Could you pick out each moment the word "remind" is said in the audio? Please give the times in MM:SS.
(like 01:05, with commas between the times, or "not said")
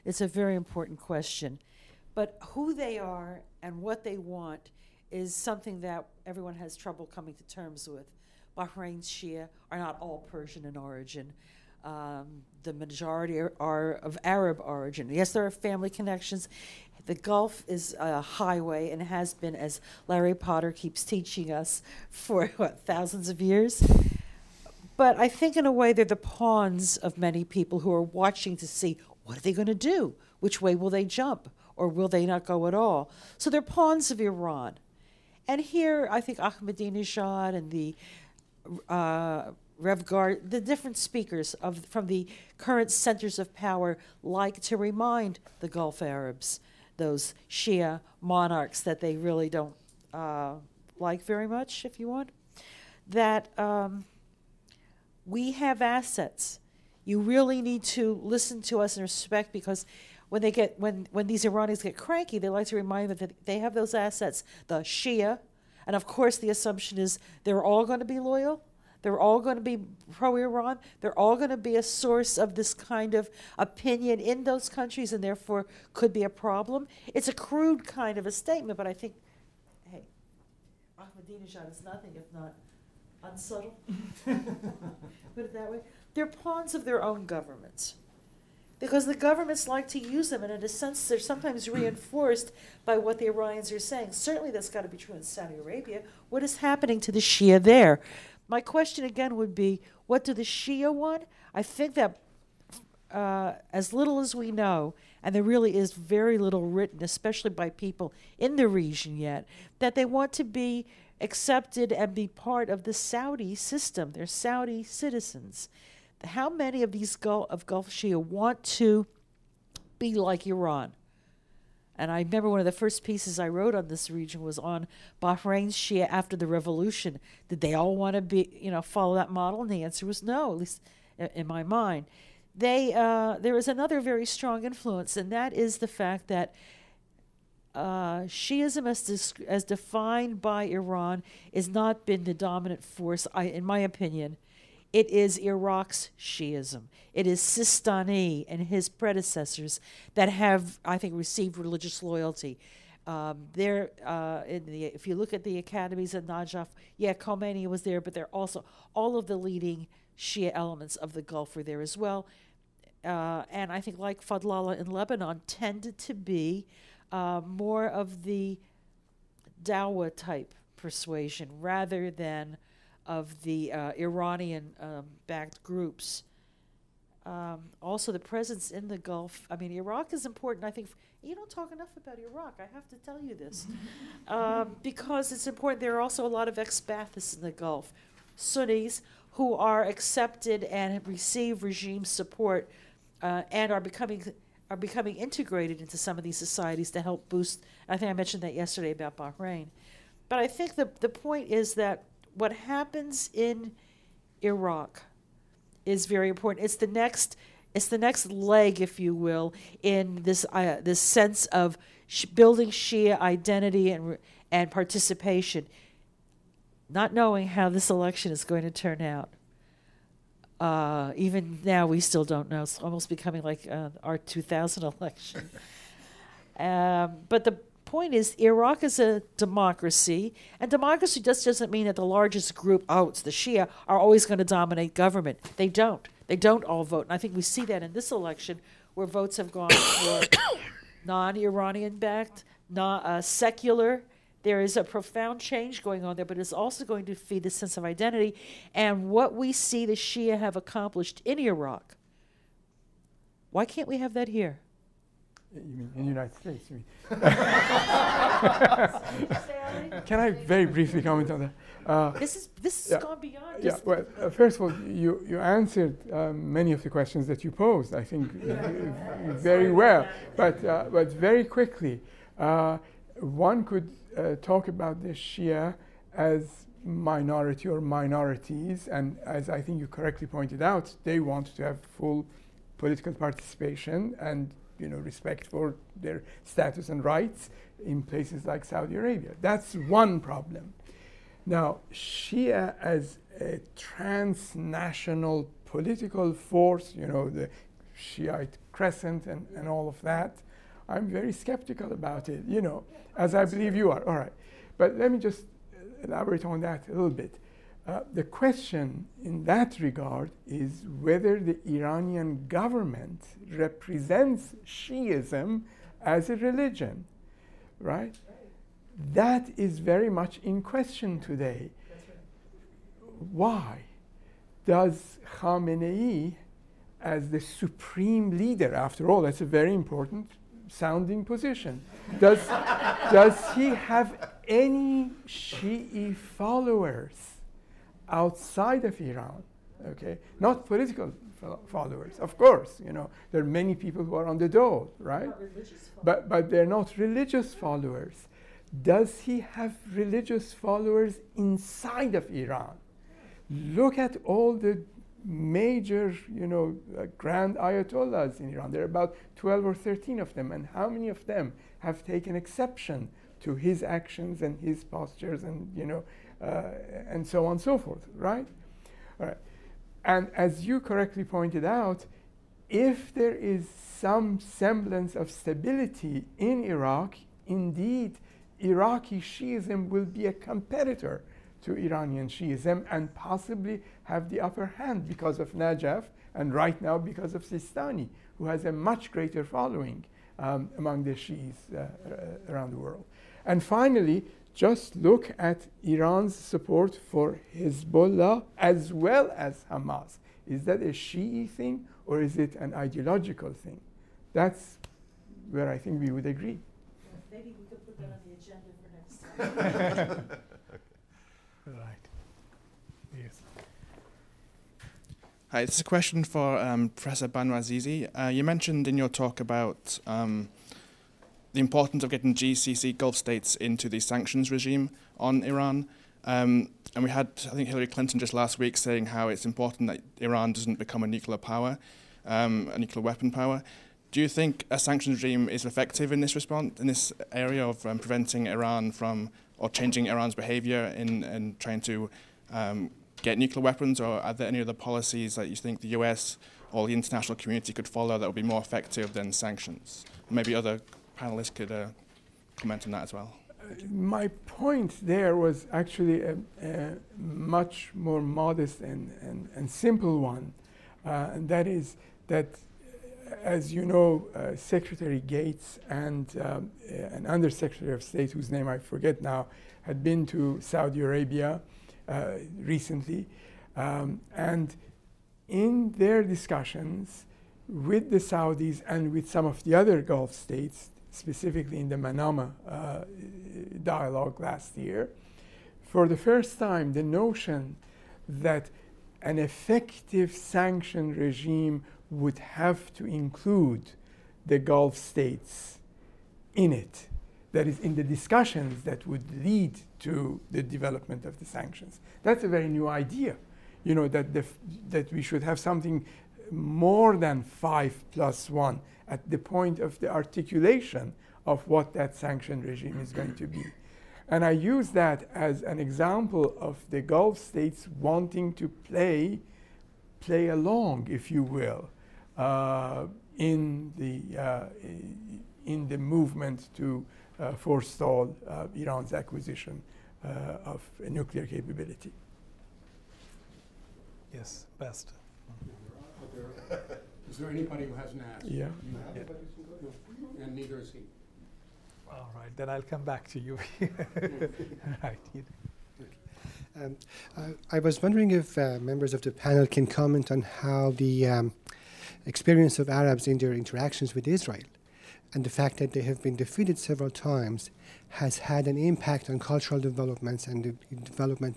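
00:44, 01:02.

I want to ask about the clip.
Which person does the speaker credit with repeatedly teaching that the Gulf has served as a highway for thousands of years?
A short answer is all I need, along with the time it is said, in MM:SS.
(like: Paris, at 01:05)
Larry Potter, at 00:20.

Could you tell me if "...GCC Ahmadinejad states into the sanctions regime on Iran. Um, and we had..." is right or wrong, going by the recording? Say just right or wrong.
wrong.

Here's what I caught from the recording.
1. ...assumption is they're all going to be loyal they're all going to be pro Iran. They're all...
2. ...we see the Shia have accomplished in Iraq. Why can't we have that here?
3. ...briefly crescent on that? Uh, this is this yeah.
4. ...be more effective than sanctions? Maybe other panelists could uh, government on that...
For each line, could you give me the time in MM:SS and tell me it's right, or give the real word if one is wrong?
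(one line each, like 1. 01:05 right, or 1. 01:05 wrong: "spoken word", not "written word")
1. 01:06 right
2. 04:09 right
3. 04:20 wrong: "comment", not "crescent"
4. 07:28 wrong: "comment", not "government".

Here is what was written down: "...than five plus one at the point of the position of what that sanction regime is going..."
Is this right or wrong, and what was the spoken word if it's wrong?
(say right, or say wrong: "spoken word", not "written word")
wrong: "articulation", not "position".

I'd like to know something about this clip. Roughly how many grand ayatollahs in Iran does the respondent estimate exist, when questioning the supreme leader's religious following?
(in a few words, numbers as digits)
12 or 13.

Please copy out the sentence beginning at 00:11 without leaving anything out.
Um, the majority are, are, of Arab origin.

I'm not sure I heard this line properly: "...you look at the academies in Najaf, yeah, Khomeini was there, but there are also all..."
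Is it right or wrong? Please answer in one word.
right.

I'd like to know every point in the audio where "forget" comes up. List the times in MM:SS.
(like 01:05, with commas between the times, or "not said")
07:48.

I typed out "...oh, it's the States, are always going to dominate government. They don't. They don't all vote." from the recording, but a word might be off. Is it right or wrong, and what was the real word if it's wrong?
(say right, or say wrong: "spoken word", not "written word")
wrong: "Shia", not "States".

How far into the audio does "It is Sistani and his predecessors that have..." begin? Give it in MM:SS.
02:27.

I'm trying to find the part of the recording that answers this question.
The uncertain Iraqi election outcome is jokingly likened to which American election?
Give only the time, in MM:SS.
03:44.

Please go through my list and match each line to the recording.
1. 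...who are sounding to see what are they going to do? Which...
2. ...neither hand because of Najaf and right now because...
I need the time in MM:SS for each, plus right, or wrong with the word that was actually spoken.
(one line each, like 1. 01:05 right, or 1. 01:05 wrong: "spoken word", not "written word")
1. 00:27 wrong: "watching", not "sounding"
2. 06:24 wrong: "upper", not "neither".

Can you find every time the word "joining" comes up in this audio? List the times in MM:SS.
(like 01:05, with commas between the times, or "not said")
not said.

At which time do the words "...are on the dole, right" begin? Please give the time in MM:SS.
05:44.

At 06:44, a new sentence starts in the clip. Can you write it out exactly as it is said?
That's where I think we would agree.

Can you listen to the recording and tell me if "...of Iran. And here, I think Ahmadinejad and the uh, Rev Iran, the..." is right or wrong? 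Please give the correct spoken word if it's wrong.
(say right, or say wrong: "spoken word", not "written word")
wrong: "Guard", not "Iran".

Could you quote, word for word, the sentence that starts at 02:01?
And I remember one of the first pieces I wrote on this region was on Bahrain's Shia after the revolution.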